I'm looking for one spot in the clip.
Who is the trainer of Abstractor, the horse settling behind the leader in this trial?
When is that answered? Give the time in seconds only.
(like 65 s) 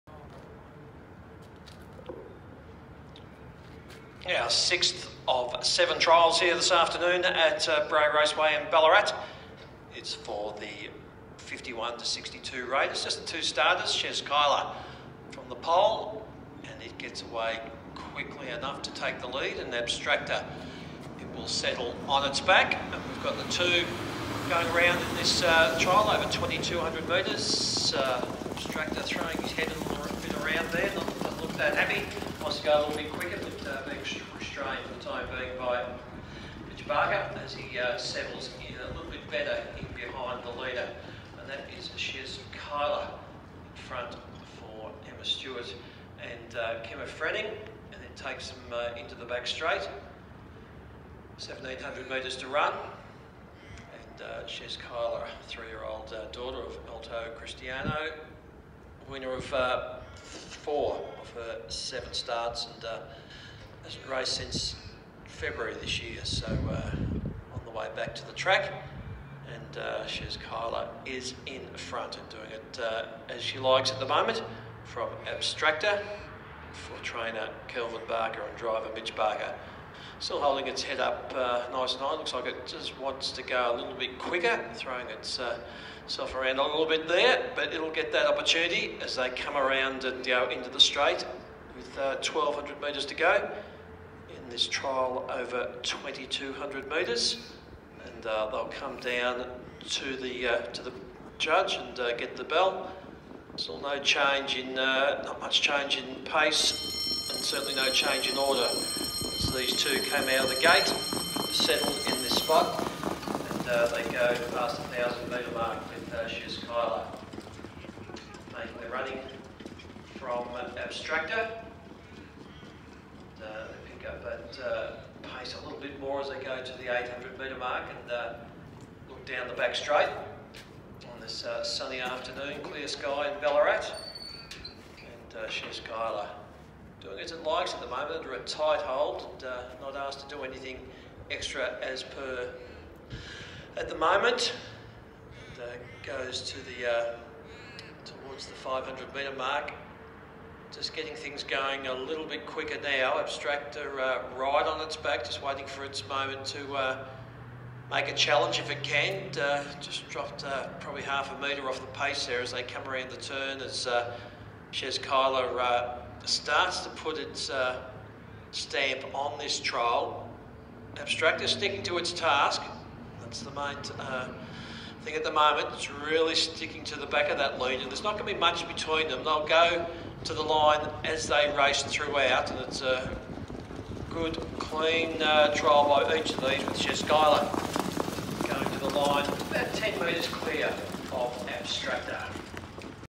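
77 s.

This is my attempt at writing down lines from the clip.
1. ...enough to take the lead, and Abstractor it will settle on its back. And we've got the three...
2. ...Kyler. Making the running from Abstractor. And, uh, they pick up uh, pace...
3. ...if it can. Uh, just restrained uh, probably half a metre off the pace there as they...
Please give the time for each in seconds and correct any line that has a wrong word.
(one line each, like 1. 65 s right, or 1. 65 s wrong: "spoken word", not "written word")
1. 18 s wrong: "two", not "three"
2. 116 s right
3. 158 s wrong: "dropped", not "restrained".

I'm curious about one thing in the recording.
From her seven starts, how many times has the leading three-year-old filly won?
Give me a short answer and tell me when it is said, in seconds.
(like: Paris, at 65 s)
4, at 60 s.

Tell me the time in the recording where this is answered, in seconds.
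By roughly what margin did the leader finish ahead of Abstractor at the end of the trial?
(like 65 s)
189 s.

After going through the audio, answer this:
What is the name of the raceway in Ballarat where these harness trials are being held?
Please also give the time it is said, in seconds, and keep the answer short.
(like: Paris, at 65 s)
Bray Raceway, at 7 s.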